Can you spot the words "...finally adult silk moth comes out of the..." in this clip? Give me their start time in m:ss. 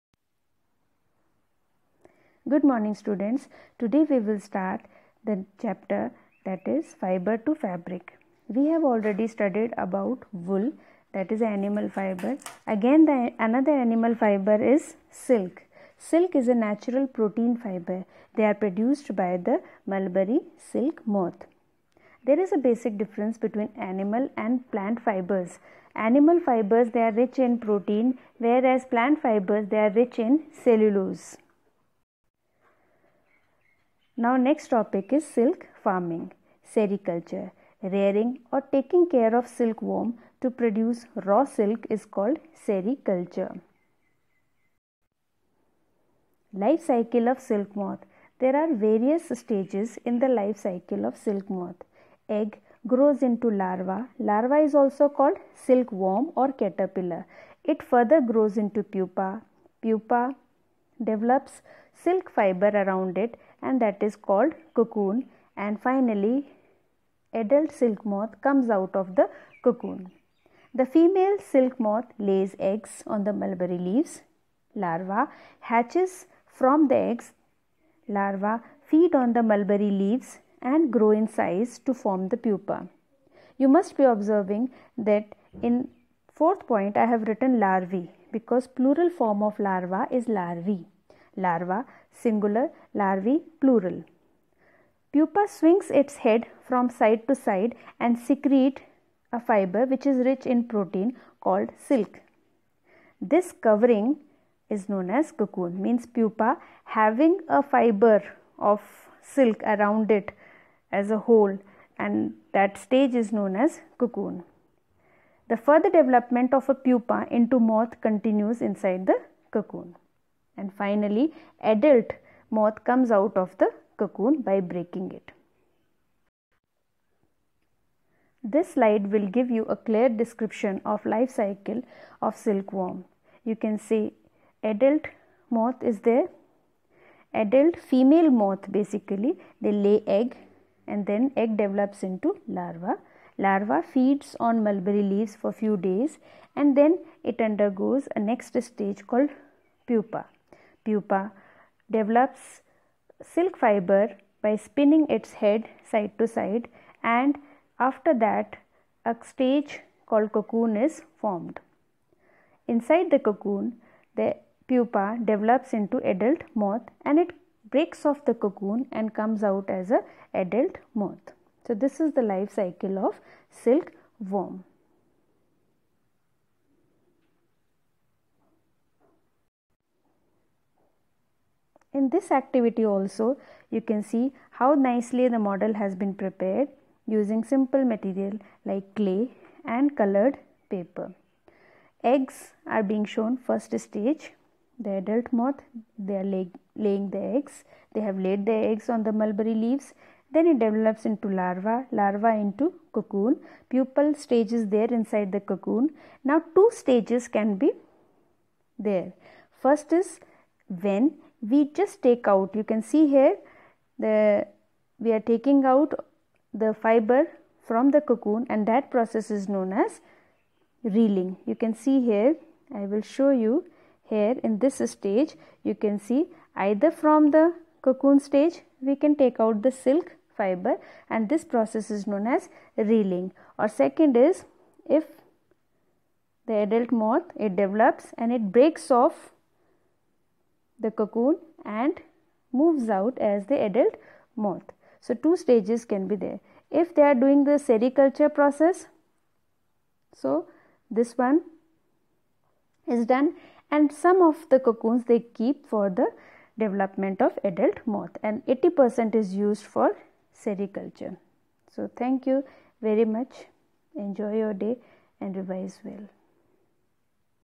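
1:05.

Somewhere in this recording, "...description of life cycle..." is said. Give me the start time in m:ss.
2:10.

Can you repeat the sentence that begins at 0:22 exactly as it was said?
There is a basic difference between animal and plant fibers.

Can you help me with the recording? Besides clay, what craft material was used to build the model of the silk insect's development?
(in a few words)
colored paper.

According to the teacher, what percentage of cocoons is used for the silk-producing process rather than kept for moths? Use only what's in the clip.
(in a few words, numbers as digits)
80%.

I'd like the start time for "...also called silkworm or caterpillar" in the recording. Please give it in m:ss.
0:54.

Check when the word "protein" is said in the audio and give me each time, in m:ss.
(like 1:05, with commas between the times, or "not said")
0:17, 0:27, 1:40.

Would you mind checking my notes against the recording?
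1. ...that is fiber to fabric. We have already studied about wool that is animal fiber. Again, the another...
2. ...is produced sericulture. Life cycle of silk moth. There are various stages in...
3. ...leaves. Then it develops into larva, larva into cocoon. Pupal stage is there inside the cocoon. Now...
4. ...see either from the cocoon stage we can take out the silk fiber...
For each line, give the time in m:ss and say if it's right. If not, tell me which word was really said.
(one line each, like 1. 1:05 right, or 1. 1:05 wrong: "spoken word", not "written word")
1. 0:06 right
2. 0:41 wrong: "called", not "produced"
3. 3:19 right
4. 3:45 right.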